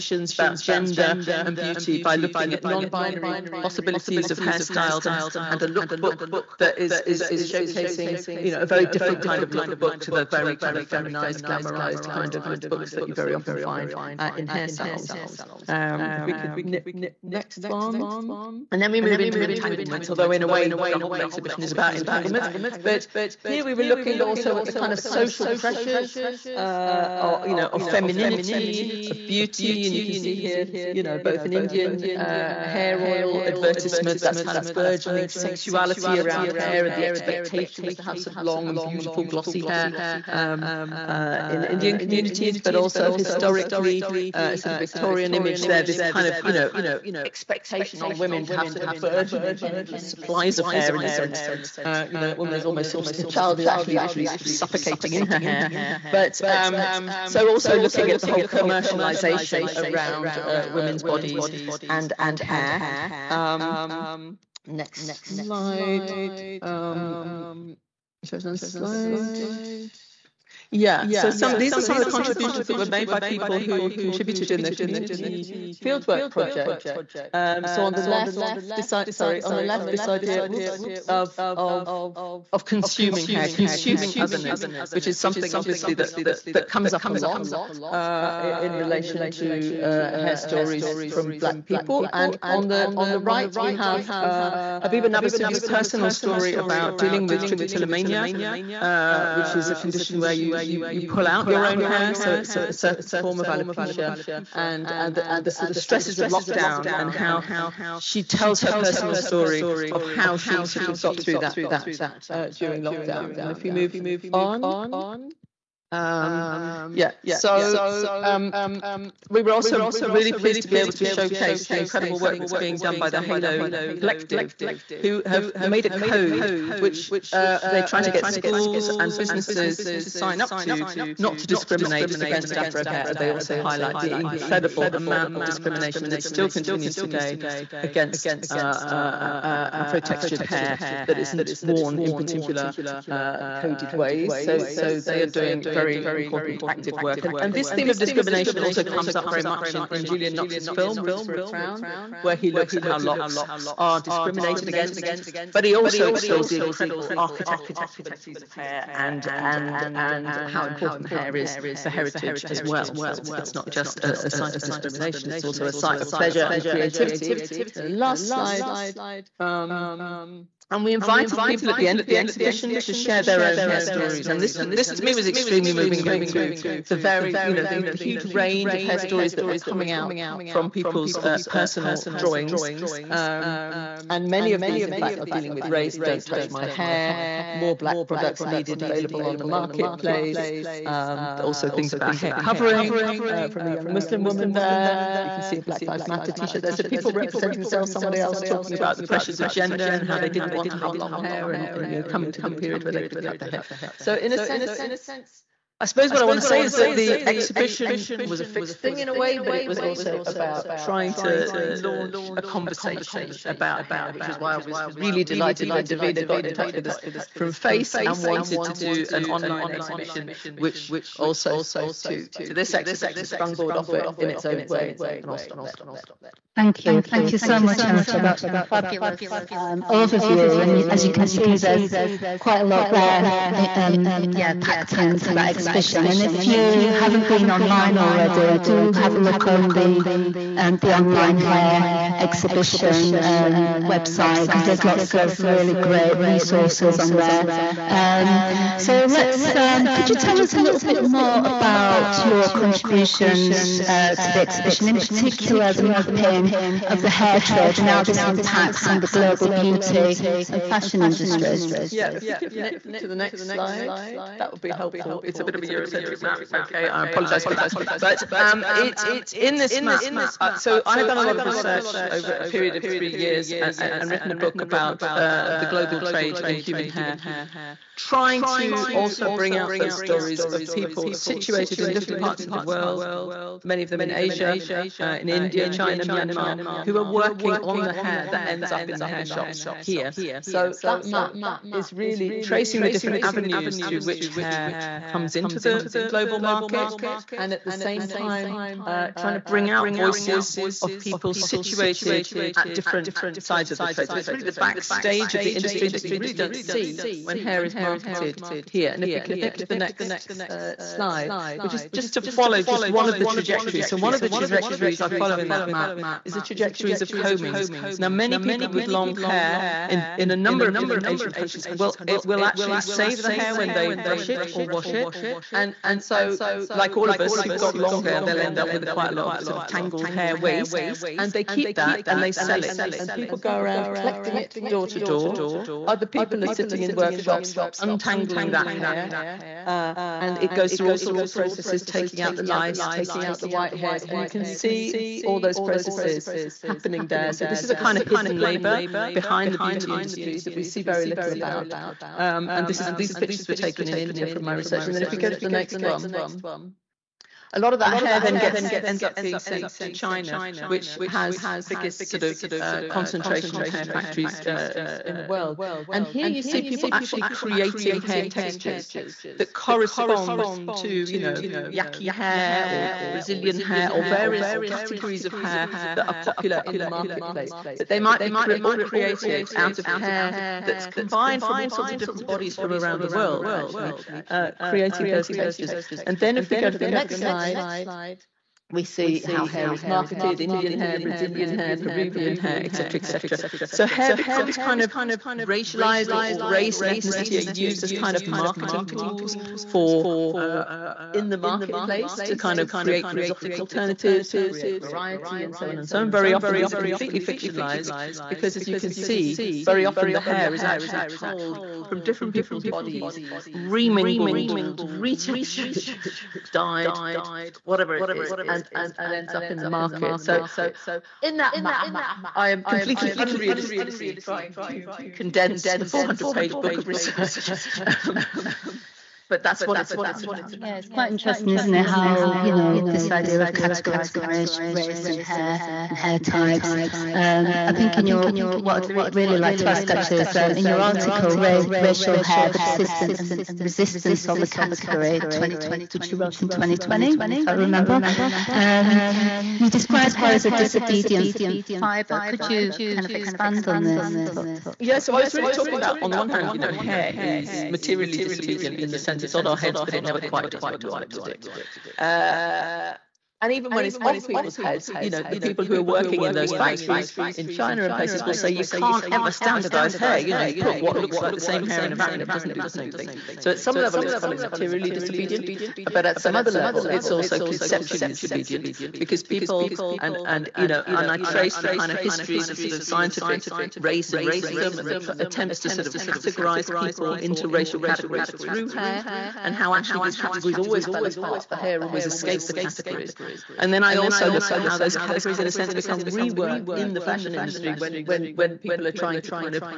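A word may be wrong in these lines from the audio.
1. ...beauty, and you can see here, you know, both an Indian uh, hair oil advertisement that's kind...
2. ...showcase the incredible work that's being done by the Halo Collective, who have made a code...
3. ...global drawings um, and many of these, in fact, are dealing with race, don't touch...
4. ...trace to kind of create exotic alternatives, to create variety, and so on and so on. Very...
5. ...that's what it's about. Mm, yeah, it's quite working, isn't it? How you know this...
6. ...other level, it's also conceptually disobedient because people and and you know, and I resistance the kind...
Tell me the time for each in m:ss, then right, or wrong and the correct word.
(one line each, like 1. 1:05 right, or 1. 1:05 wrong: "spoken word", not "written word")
1. 0:29 right
2. 2:01 right
3. 3:01 wrong: "personal", not "global"
4. 6:41 wrong: "marketplace", not "trace"
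5. 7:09 wrong: "interesting", not "working"
6. 7:56 wrong: "trace", not "resistance".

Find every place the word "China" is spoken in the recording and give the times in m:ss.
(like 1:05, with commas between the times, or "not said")
4:45, 5:59, 7:47.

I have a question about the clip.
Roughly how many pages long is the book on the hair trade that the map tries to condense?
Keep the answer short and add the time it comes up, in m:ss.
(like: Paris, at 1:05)
400, at 7:05.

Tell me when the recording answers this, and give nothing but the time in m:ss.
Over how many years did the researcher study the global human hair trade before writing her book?
4:32.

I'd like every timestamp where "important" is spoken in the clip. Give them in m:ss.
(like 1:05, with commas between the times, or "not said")
2:26, 2:40.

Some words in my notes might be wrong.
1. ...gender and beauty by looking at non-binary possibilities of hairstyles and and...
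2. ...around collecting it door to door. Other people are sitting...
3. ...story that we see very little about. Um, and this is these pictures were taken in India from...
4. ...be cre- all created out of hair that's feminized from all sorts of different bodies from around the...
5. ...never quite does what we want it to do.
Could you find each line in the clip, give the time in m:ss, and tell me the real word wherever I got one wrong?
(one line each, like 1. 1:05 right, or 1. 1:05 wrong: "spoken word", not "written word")
1. 0:00 right
2. 5:33 right
3. 5:49 wrong: "industry", not "story"
4. 6:18 wrong: "combined", not "feminized"
5. 7:40 right.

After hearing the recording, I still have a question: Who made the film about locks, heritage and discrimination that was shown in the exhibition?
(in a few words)
Julian Knox.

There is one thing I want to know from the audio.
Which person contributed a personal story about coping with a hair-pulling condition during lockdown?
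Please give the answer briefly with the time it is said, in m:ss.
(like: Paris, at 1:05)
Habiba Nabasubi, at 1:34.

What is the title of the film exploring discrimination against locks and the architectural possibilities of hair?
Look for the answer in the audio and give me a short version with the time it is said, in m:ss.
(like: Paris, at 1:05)
Roots for a Crown, at 2:30.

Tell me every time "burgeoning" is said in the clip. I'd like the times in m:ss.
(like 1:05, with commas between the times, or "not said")
0:34, 0:48.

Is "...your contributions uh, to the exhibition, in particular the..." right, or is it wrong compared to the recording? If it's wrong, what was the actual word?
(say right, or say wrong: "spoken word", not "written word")
right.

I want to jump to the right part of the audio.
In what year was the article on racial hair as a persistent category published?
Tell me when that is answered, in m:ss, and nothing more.
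7:26.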